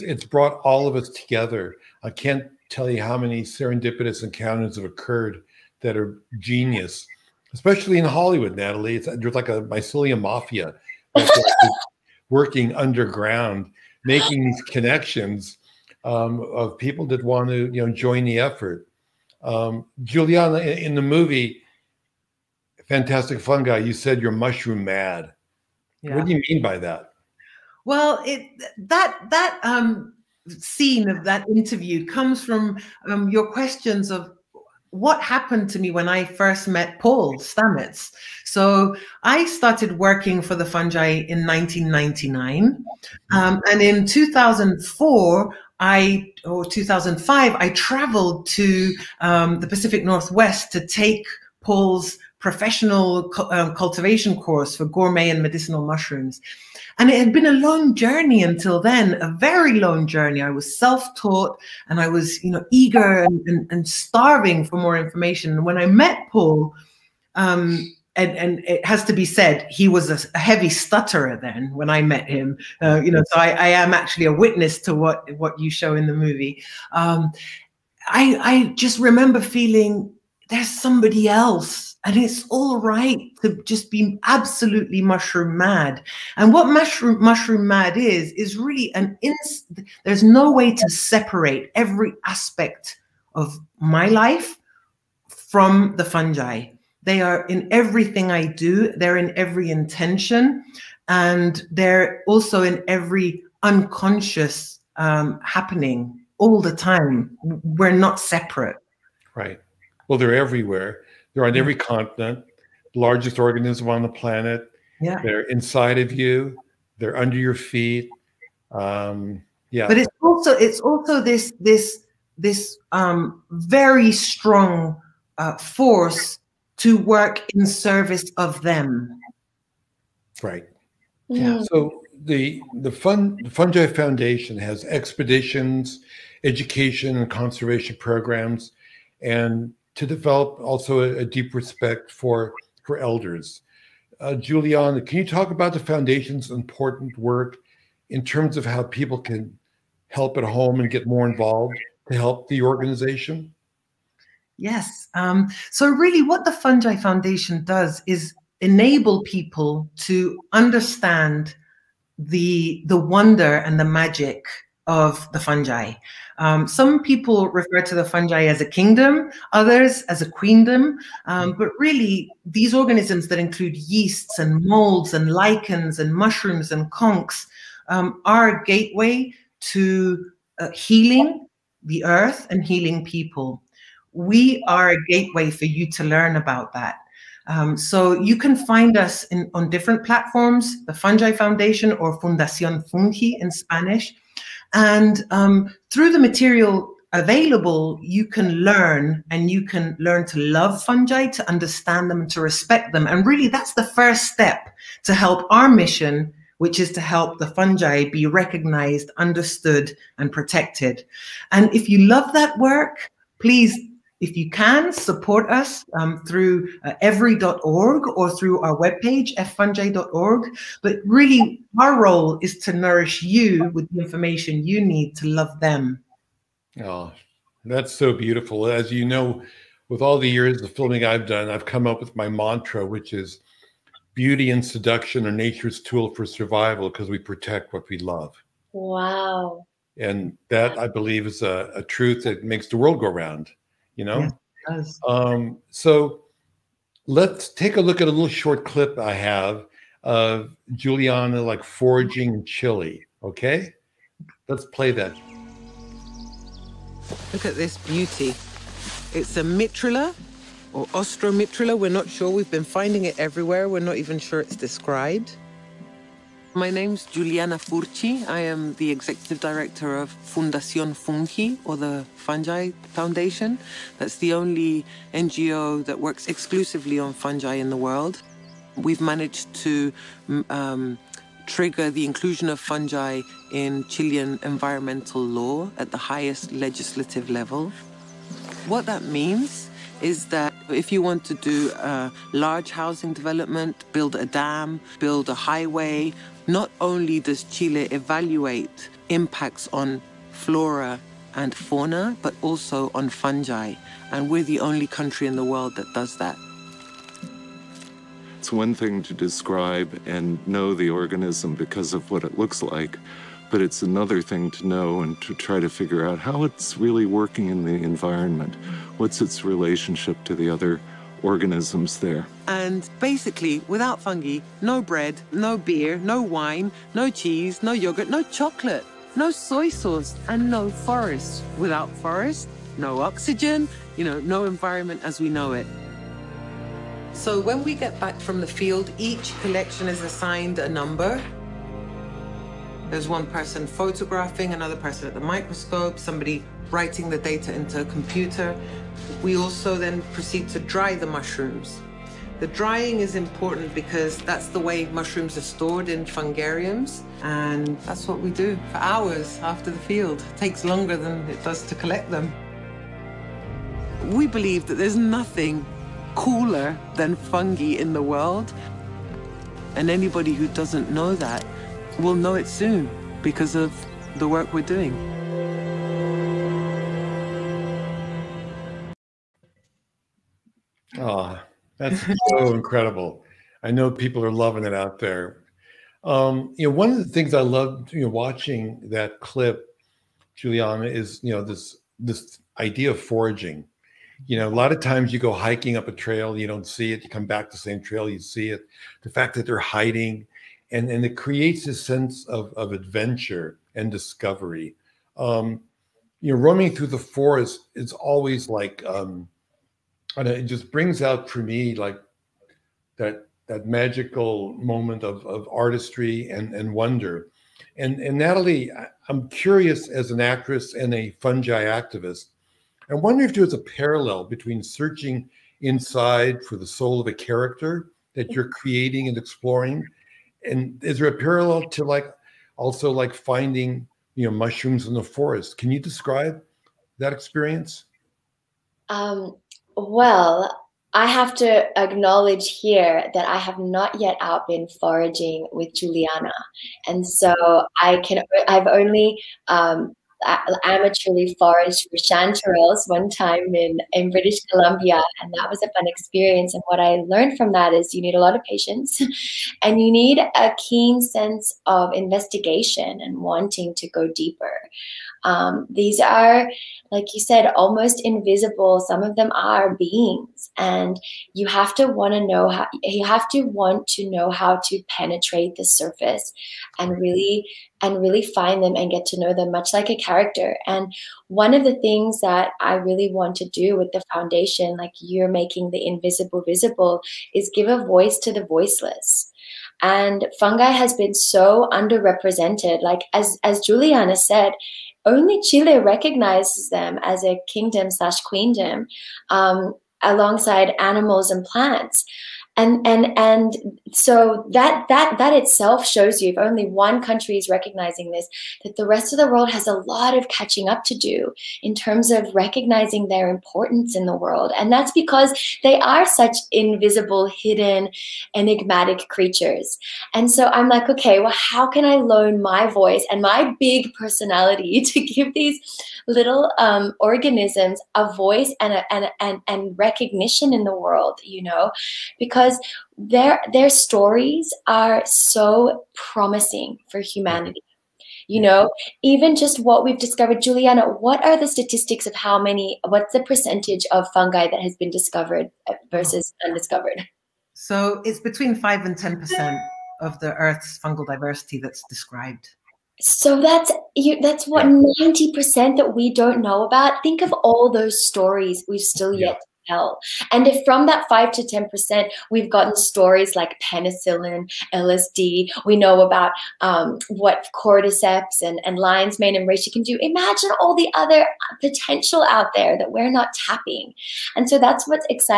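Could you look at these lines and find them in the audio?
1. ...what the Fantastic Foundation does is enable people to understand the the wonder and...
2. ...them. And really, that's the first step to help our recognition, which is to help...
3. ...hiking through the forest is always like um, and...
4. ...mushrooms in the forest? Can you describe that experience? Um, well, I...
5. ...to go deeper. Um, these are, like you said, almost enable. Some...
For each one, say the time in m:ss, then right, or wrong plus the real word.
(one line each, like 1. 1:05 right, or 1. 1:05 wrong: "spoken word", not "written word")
1. 2:36 wrong: "Fungi", not "Fantastic"
2. 3:22 wrong: "mission", not "recognition"
3. 6:46 wrong: "roaming", not "hiking"
4. 7:14 right
5. 7:43 wrong: "invisible", not "enable".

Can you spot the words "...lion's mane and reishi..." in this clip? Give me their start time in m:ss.
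9:28.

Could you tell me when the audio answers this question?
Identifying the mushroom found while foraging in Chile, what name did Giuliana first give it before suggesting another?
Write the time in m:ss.
4:19.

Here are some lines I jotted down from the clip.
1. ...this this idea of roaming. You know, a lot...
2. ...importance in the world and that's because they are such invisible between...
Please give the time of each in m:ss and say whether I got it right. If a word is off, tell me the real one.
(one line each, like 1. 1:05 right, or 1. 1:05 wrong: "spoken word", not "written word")
1. 6:31 wrong: "foraging", not "roaming"
2. 8:33 wrong: "hidden", not "between".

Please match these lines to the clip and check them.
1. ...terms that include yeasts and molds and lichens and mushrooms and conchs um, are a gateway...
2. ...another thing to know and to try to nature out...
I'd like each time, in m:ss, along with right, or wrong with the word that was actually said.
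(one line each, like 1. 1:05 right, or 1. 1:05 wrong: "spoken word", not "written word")
1. 2:52 wrong: "organisms", not "terms"
2. 5:13 wrong: "figure", not "nature".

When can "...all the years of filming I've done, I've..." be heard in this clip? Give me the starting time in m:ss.
3:50.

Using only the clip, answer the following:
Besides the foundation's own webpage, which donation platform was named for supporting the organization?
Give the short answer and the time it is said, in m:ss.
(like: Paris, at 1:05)
every.org, at 3:37.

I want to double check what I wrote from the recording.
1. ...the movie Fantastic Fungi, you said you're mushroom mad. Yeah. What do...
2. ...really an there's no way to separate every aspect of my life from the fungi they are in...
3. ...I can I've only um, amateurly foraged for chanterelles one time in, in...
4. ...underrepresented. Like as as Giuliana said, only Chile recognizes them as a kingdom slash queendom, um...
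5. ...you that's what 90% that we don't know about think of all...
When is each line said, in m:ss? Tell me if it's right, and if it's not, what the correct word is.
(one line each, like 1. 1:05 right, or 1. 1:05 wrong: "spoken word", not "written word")
1. 0:20 right
2. 1:28 right
3. 7:27 right
4. 8:11 right
5. 9:13 right.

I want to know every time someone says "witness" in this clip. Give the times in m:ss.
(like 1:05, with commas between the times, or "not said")
1:14.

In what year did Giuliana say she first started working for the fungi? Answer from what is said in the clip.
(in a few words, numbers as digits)
1999.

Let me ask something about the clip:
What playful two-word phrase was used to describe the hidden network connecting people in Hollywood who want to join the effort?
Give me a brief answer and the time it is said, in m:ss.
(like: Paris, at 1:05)
mycelium mafia, at 0:09.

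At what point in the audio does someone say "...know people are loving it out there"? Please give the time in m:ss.
6:23.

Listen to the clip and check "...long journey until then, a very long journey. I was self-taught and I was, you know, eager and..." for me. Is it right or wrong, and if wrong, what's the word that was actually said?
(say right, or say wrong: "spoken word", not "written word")
right.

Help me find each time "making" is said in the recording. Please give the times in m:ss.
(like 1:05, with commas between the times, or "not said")
0:14, 8:05.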